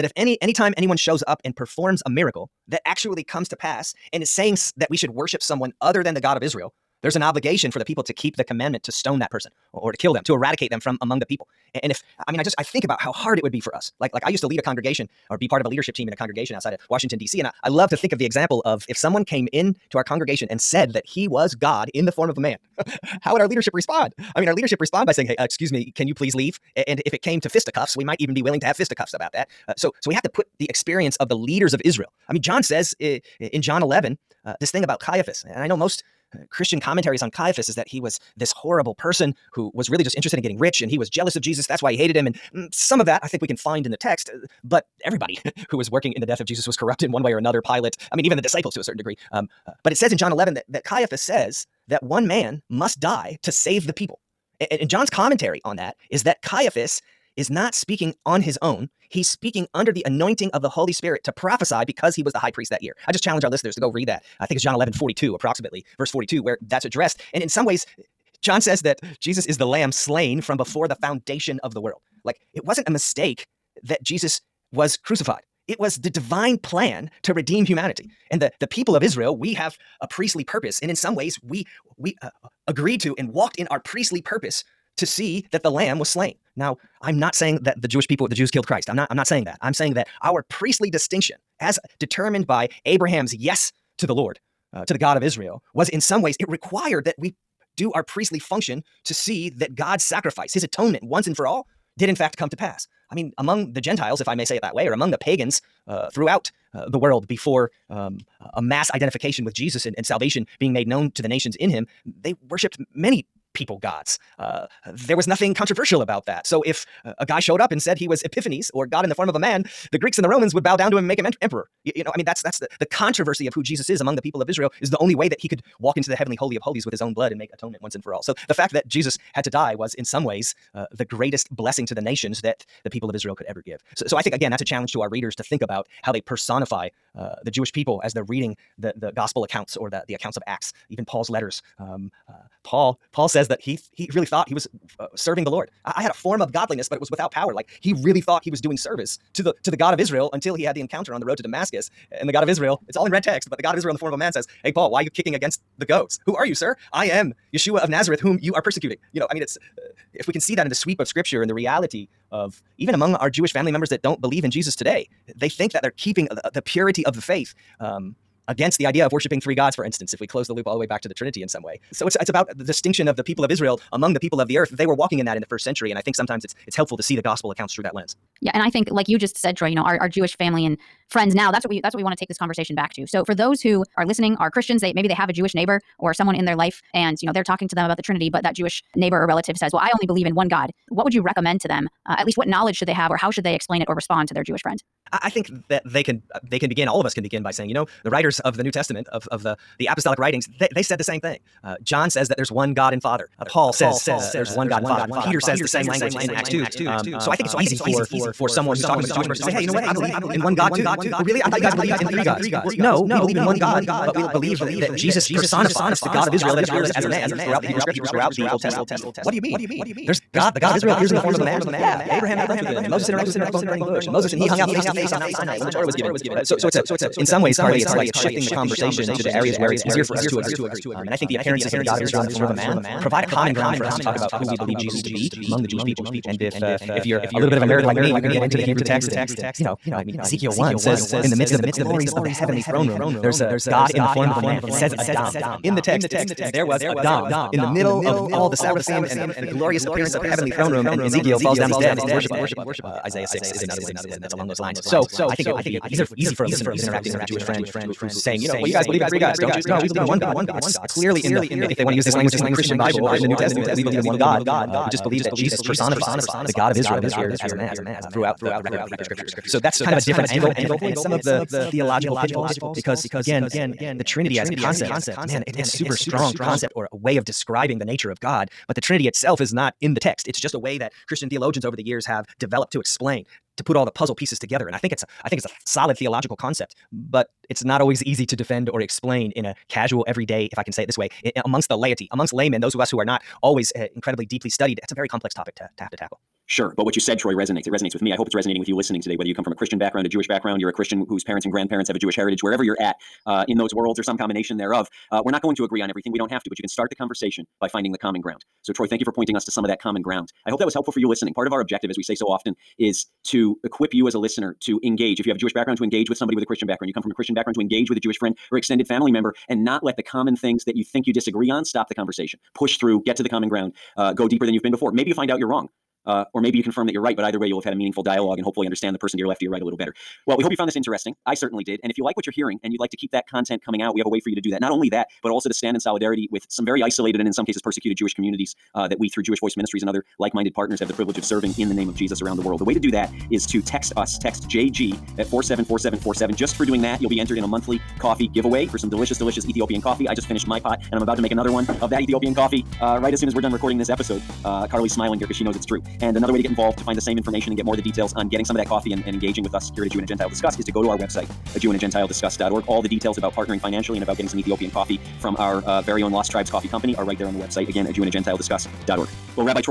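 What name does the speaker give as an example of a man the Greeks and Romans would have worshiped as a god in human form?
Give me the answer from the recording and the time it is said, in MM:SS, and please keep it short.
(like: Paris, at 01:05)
Epiphanes, at 01:58.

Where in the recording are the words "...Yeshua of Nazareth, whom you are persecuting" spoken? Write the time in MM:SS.
02:37.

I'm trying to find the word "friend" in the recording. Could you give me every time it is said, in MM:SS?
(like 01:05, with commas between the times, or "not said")
03:01, 03:14, 04:17, 05:18.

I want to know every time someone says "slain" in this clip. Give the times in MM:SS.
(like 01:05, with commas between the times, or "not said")
01:09, 01:26.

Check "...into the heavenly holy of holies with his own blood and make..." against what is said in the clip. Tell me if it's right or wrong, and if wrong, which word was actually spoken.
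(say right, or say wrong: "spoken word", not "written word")
right.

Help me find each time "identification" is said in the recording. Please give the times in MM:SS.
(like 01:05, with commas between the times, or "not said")
01:48.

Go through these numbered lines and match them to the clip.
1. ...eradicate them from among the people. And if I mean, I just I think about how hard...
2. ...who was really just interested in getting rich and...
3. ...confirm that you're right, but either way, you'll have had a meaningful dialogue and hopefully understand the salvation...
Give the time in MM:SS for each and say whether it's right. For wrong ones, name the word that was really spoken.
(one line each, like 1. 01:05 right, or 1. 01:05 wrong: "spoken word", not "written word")
1. 00:10 right
2. 00:39 right
3. 05:26 wrong: "person", not "salvation".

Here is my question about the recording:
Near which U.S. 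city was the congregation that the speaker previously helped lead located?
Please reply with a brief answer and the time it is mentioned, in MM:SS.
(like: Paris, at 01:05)
Washington D.C., at 00:16.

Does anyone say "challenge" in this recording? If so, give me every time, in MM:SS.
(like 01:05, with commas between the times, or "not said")
01:03, 02:14.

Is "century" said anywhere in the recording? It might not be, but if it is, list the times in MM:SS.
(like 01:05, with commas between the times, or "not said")
02:55.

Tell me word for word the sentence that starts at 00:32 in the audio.
I mean, John says eh, eh, in John 11 uh, this thing about Caiaphas, and I know most.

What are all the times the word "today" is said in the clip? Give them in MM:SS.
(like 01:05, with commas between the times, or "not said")
02:44, 04:59.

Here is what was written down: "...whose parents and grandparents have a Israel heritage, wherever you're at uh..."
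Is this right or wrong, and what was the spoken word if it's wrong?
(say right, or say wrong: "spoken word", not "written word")
wrong: "Jewish", not "Israel".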